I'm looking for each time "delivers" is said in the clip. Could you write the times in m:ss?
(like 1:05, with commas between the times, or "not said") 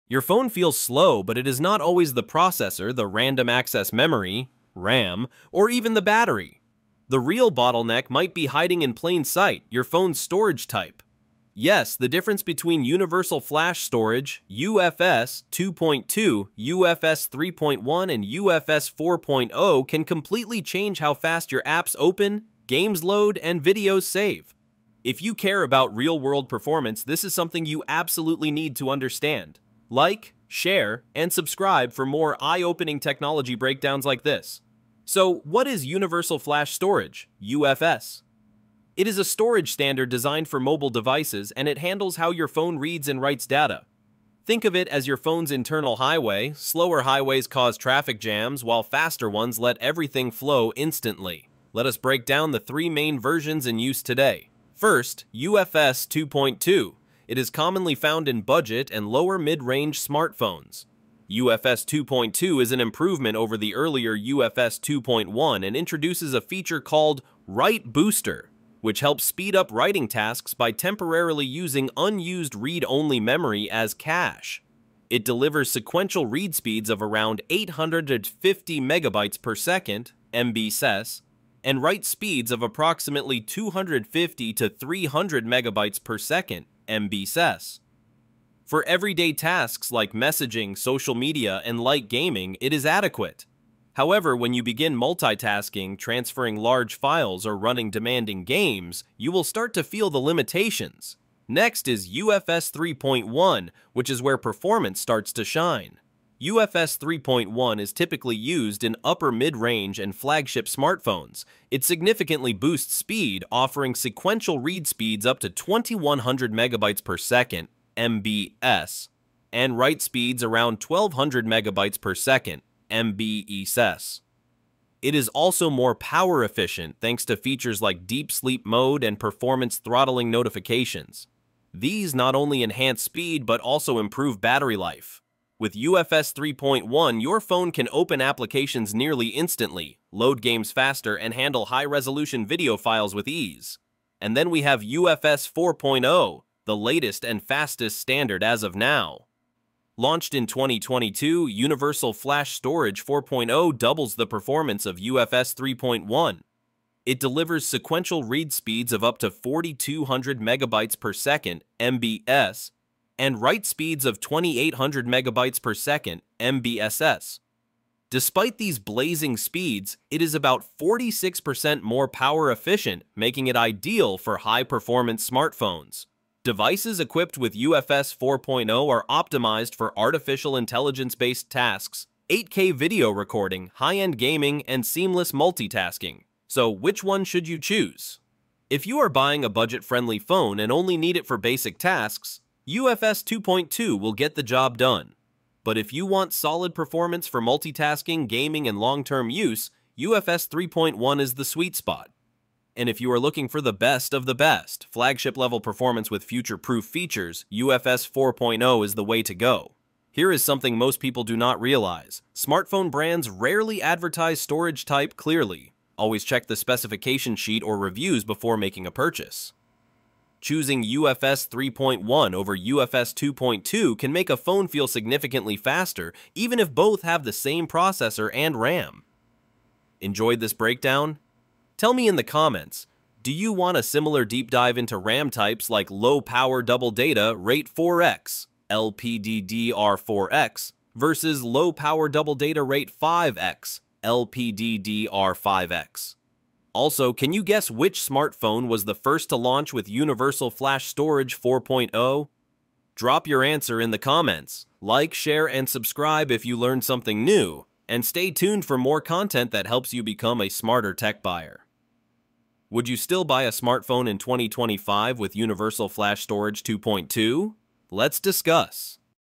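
1:15, 2:37.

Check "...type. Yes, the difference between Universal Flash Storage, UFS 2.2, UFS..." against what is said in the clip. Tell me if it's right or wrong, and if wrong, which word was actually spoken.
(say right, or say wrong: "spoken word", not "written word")
right.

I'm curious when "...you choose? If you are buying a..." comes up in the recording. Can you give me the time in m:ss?
3:07.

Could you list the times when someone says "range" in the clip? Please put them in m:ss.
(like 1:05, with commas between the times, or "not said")
0:59, 1:49.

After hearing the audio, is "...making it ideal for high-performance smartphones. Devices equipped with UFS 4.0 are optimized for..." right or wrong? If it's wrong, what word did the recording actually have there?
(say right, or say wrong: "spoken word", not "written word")
right.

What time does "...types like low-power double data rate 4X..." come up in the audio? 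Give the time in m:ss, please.
3:55.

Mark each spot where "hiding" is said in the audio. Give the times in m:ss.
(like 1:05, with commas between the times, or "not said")
0:08.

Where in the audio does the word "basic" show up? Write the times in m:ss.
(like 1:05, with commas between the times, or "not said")
3:11.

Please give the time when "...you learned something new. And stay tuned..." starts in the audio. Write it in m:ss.
4:16.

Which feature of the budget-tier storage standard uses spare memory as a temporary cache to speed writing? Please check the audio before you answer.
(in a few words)
Write Booster.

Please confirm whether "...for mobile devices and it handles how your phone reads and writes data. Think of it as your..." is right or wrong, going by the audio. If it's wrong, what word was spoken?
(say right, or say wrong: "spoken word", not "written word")
right.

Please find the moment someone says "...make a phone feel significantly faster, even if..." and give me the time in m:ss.
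3:44.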